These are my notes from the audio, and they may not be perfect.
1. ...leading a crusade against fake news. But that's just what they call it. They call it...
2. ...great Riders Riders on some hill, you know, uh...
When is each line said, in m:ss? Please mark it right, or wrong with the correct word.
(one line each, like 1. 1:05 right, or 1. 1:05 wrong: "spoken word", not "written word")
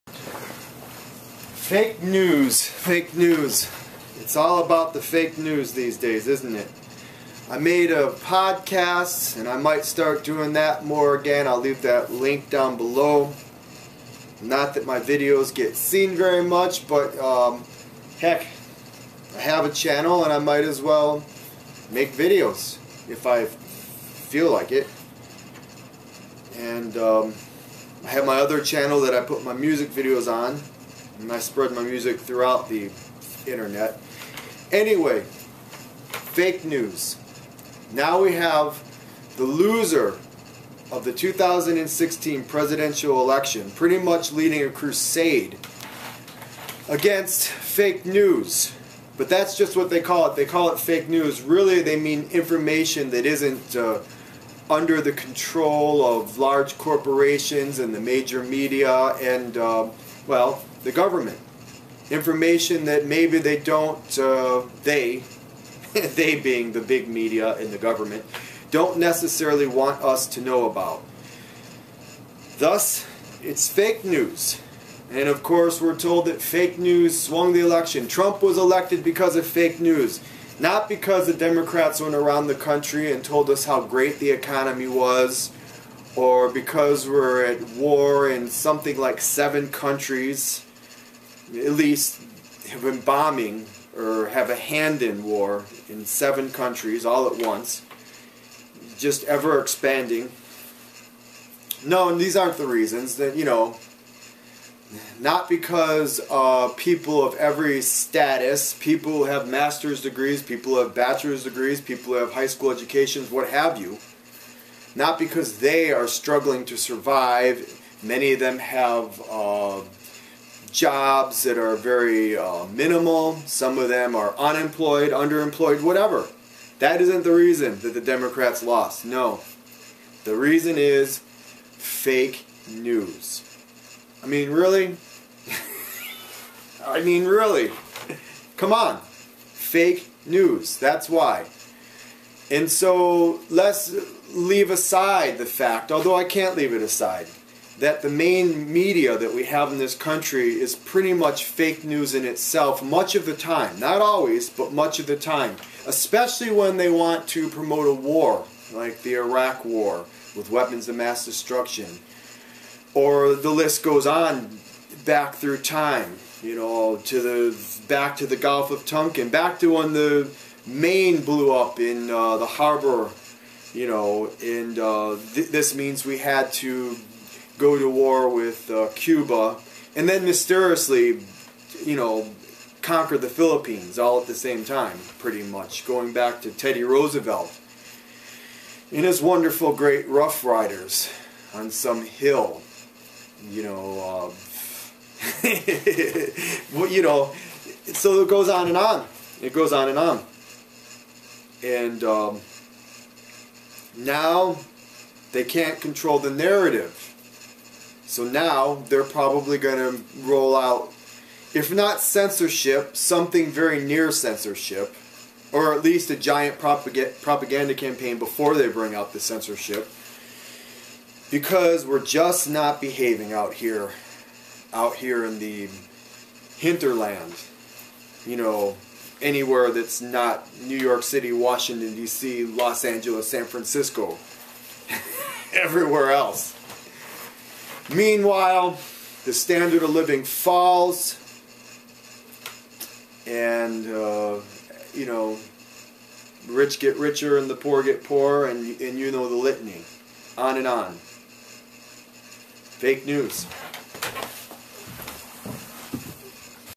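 1. 0:44 right
2. 3:09 wrong: "Rough", not "Riders".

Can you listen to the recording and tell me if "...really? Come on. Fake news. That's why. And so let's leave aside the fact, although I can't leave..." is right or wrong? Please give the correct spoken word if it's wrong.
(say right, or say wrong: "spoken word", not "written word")
right.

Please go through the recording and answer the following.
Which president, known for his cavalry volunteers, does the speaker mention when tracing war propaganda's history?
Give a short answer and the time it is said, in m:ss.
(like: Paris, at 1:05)
Teddy Roosevelt, at 3:06.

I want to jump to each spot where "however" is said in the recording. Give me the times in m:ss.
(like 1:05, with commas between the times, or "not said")
not said.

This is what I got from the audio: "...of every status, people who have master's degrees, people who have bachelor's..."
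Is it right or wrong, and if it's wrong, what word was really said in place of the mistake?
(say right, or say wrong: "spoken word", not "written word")
right.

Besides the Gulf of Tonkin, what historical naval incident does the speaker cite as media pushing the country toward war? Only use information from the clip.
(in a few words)
the Maine blew up.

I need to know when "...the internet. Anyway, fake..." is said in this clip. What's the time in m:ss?
0:32.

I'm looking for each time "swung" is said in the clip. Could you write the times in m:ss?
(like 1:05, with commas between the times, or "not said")
1:17.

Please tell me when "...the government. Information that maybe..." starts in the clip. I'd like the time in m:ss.
1:00.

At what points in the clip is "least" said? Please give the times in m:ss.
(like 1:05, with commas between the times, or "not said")
1:31, 3:35.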